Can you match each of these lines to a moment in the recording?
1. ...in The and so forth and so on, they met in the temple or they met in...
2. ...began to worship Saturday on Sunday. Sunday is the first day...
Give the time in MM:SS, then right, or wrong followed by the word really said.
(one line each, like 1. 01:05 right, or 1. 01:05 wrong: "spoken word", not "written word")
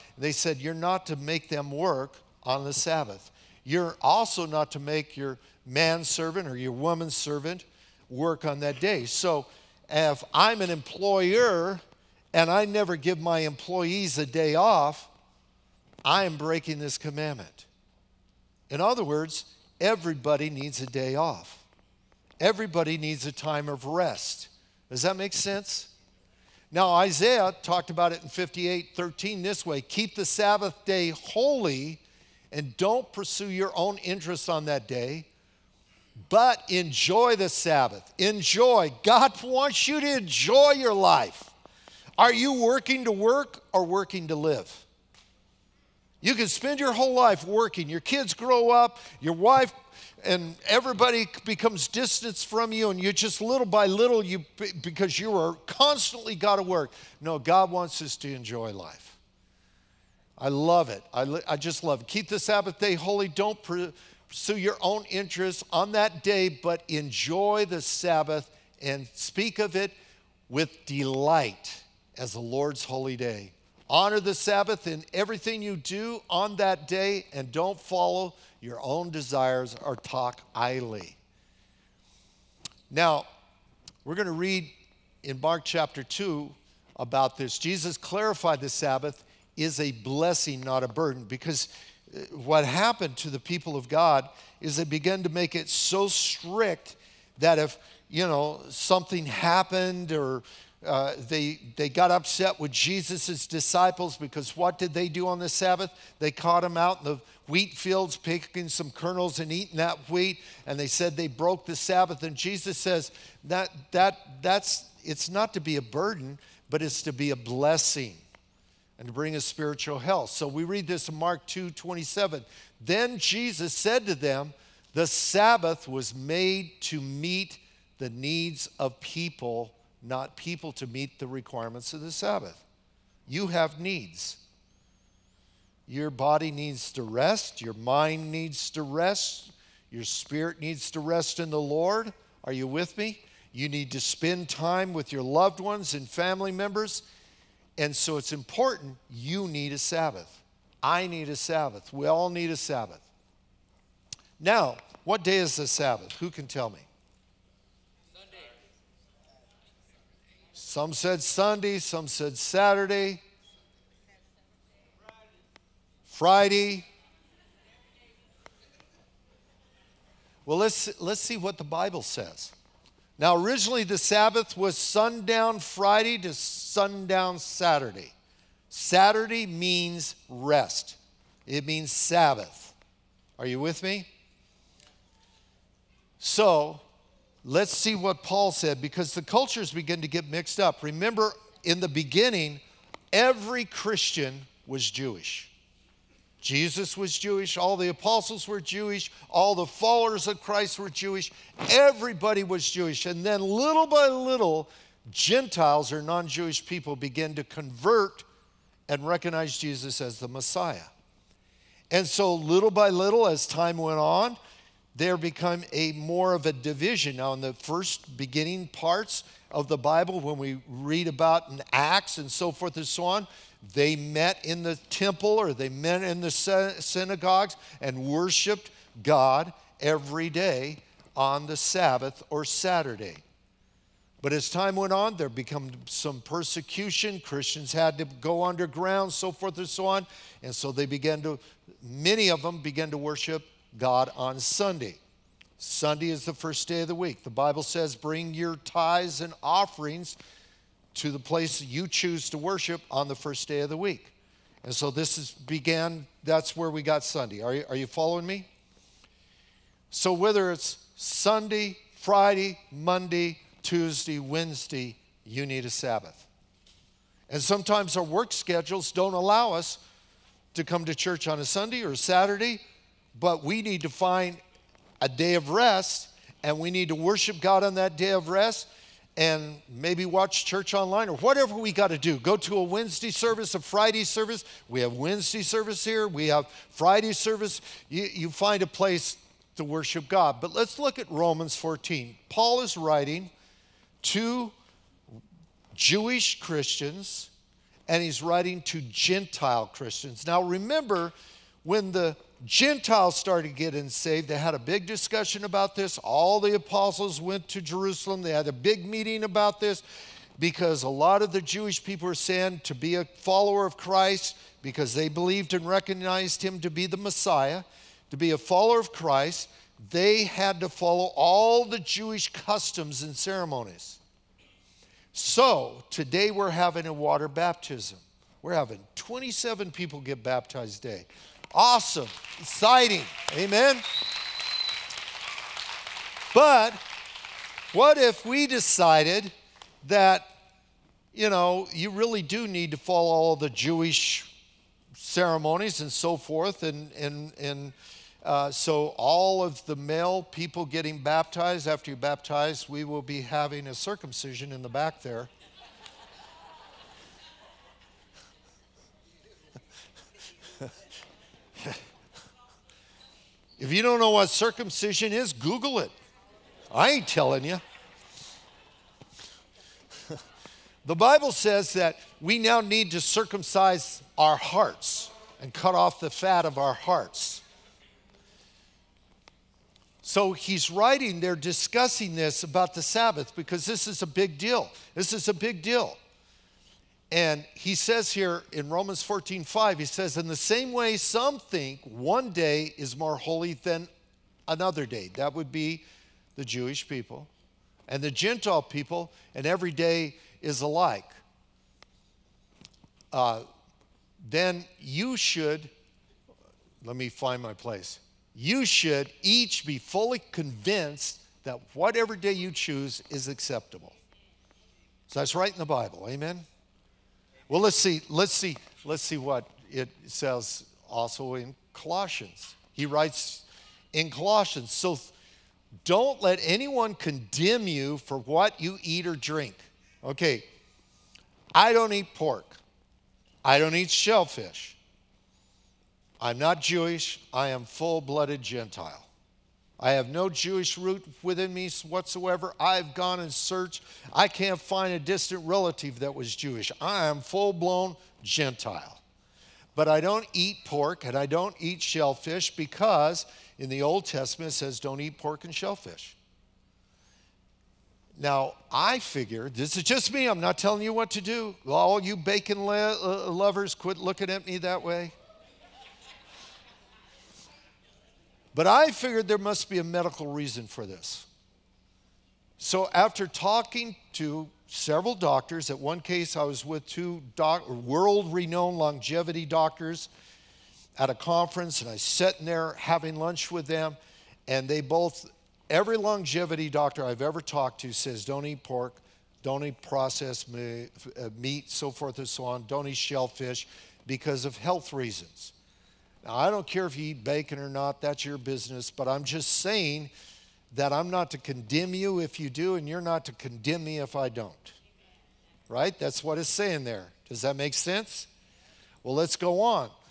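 1. 03:41 wrong: "Acts", not "The"
2. 04:02 wrong: "God", not "Saturday".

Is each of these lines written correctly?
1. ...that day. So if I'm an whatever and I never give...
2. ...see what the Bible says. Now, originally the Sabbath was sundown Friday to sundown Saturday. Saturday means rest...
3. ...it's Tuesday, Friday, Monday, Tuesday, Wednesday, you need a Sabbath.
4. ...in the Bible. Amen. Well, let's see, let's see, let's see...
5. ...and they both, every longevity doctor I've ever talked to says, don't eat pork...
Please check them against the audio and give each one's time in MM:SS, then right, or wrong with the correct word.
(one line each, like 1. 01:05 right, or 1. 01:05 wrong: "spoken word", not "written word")
1. 00:08 wrong: "employer", not "whatever"
2. 02:51 right
3. 04:20 wrong: "Sunday", not "Tuesday"
4. 06:55 right
5. 08:04 right.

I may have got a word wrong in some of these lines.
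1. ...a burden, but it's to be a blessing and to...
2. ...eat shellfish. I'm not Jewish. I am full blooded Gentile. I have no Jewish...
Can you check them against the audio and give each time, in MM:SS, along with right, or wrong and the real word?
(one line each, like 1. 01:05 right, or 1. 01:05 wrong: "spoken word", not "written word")
1. 01:55 right
2. 07:13 right.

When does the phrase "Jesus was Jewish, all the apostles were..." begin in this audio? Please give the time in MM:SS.
03:16.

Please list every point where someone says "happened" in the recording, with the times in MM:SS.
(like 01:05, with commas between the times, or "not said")
01:32, 01:39.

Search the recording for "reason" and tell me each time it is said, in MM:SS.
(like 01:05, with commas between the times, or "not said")
07:50, 08:14.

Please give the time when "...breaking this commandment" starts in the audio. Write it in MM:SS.
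00:16.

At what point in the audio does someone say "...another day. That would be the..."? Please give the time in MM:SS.
06:34.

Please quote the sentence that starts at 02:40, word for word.
Some said Sunday, some said Saturday, Friday.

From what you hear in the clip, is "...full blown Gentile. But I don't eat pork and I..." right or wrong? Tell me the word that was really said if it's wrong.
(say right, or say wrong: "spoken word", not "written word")
right.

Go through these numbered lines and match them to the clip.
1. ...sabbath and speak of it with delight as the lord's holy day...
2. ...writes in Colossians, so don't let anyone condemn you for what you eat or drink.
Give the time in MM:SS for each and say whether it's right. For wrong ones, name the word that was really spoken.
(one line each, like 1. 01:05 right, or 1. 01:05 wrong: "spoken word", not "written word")
1. 01:07 right
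2. 07:02 right.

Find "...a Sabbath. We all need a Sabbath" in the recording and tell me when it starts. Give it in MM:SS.
02:31.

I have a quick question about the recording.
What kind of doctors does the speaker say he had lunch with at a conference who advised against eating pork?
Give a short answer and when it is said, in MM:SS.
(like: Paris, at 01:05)
Longevity doctors, at 07:58.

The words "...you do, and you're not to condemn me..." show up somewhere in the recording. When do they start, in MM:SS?
08:22.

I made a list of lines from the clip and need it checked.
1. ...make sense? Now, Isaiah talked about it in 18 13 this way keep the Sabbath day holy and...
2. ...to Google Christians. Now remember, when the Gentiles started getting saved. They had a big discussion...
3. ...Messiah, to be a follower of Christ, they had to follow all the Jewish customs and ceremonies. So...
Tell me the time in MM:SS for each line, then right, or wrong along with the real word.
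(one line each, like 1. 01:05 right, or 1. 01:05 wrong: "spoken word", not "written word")
1. 00:25 wrong: "58", not "18"
2. 04:58 wrong: "Gentile", not "Google"
3. 05:16 right.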